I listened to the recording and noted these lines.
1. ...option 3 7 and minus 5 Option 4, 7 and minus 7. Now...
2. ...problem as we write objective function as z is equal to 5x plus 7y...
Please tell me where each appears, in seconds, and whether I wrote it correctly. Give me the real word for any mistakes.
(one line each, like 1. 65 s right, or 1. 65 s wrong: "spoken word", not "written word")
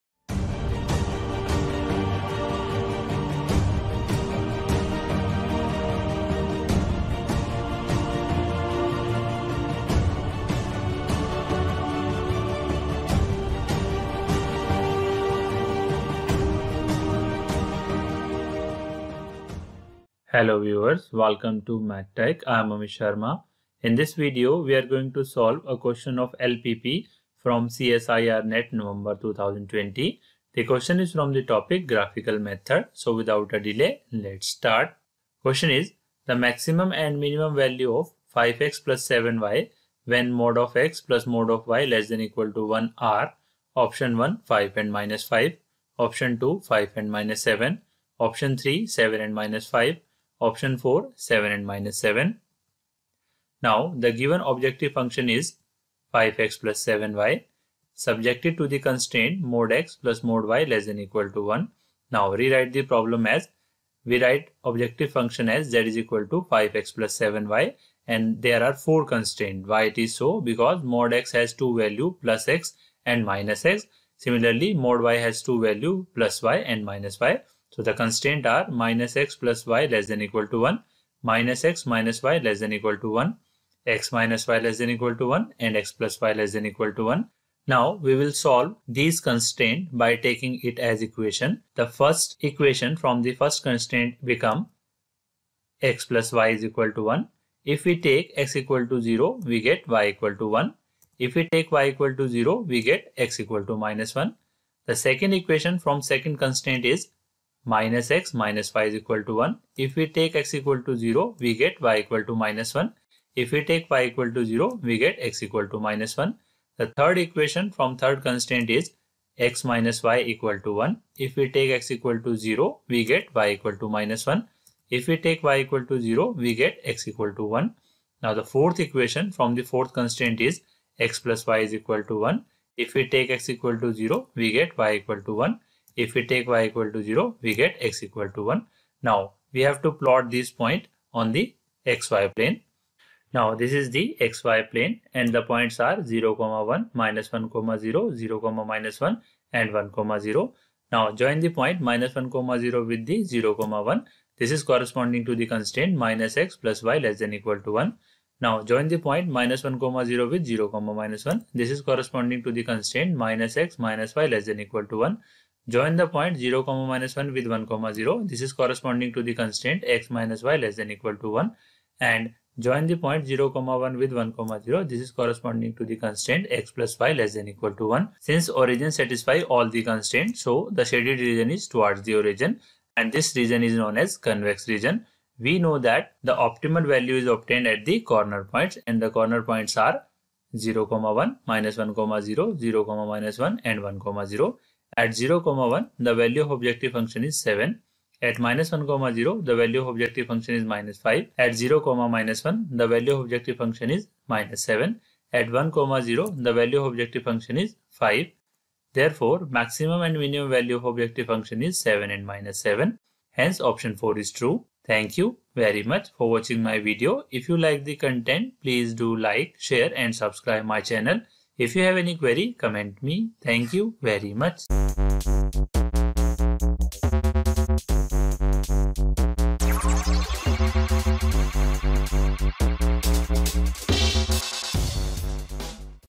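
1. 48 s right
2. 62 s right.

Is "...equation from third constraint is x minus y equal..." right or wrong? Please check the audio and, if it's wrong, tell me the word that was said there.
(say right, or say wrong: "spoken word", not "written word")
right.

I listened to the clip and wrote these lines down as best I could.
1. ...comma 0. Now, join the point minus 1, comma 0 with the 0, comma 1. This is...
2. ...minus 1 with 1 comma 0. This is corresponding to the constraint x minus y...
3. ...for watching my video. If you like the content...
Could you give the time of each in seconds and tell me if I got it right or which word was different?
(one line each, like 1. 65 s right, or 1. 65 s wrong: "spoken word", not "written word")
1. 149 s right
2. 166 s right
3. 216 s right.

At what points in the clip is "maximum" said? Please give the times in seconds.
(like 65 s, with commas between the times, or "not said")
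36 s, 209 s.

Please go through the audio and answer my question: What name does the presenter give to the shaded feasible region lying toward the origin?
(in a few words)
convex region.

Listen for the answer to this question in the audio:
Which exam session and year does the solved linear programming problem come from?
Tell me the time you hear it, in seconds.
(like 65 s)
27 s.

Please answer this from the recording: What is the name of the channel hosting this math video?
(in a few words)
Math Tecz.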